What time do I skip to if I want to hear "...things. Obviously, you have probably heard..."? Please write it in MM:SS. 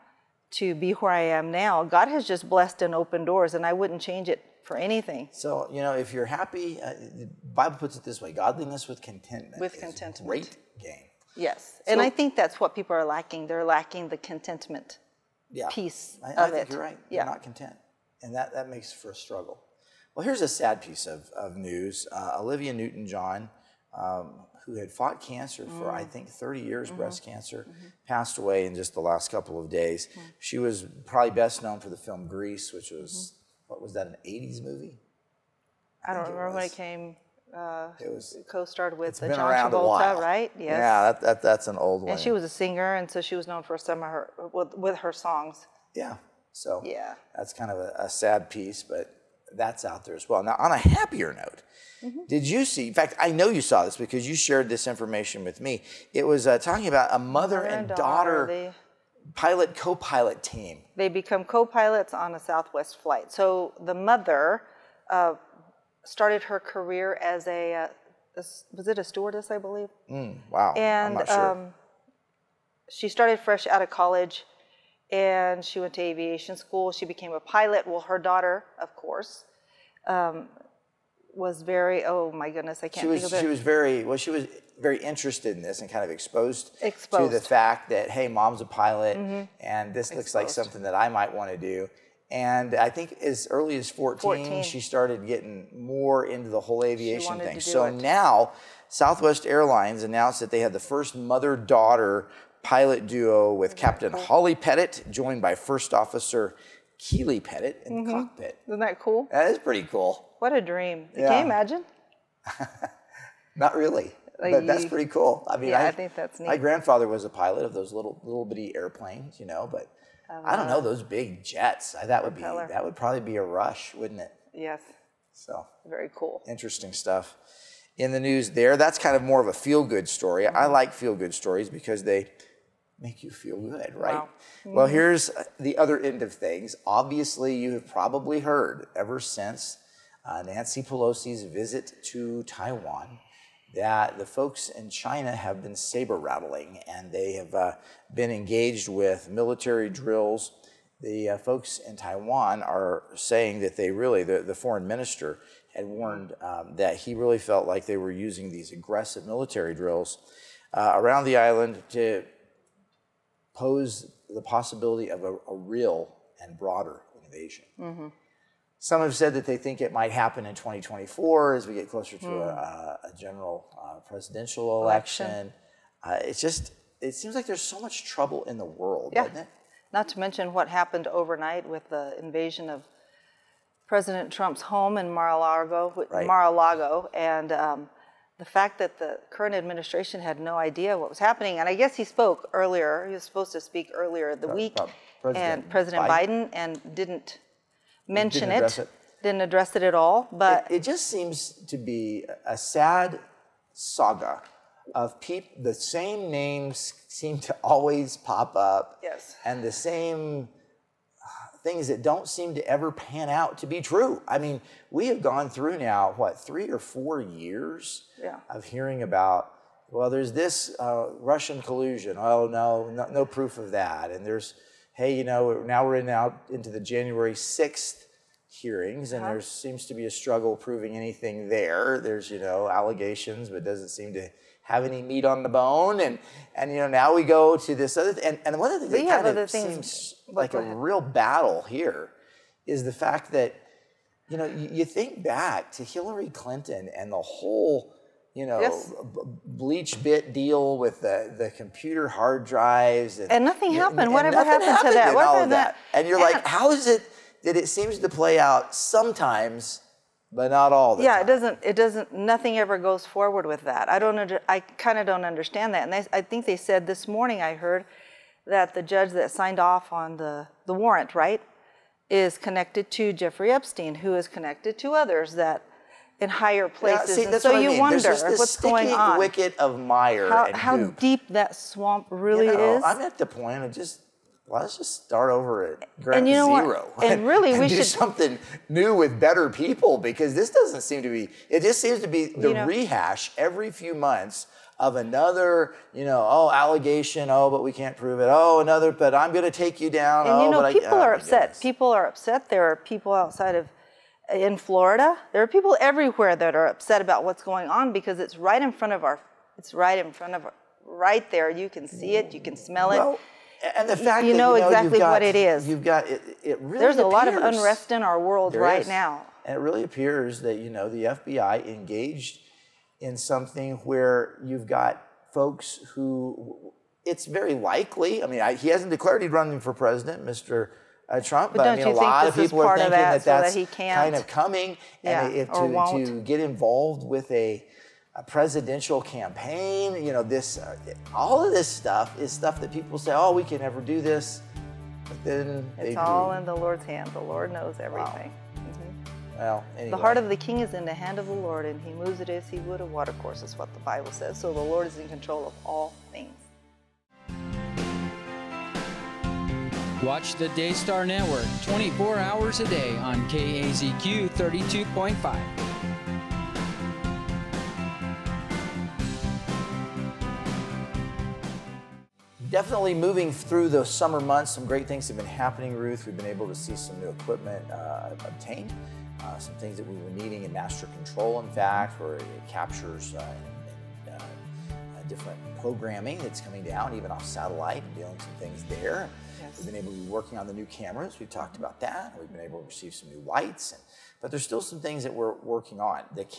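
02:16.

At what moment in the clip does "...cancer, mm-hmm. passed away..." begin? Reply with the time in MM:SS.
00:27.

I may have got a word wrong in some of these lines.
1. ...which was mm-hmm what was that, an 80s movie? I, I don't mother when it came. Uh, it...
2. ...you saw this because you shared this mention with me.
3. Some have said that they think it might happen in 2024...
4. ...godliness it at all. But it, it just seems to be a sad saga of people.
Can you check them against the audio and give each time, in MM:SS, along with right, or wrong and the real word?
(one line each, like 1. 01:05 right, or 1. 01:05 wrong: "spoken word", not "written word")
1. 00:32 wrong: "remember", not "mother"
2. 00:53 wrong: "information", not "mention"
3. 02:48 right
4. 03:19 wrong: "address", not "godliness".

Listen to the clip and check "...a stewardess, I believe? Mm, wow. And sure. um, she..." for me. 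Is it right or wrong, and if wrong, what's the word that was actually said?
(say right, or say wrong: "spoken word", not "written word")
right.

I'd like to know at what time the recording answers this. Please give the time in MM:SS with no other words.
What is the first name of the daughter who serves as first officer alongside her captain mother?
01:46.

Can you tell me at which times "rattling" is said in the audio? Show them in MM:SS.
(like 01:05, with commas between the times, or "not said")
02:26.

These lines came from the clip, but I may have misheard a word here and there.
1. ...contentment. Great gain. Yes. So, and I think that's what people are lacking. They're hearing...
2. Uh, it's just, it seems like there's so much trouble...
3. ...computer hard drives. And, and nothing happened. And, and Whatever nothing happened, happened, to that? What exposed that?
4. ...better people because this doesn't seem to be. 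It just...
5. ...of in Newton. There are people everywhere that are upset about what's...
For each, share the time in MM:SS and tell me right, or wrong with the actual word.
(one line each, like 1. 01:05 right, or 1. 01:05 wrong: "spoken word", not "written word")
1. 00:09 wrong: "lacking", not "hearing"
2. 02:56 right
3. 04:11 wrong: "happened", not "exposed"
4. 04:49 right
5. 05:03 wrong: "Florida", not "Newton".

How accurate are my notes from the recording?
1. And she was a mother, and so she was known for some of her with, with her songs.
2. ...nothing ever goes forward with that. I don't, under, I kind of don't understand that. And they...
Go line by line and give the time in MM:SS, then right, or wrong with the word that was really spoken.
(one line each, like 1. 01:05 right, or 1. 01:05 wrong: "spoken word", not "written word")
1. 00:42 wrong: "singer", not "mother"
2. 04:22 right.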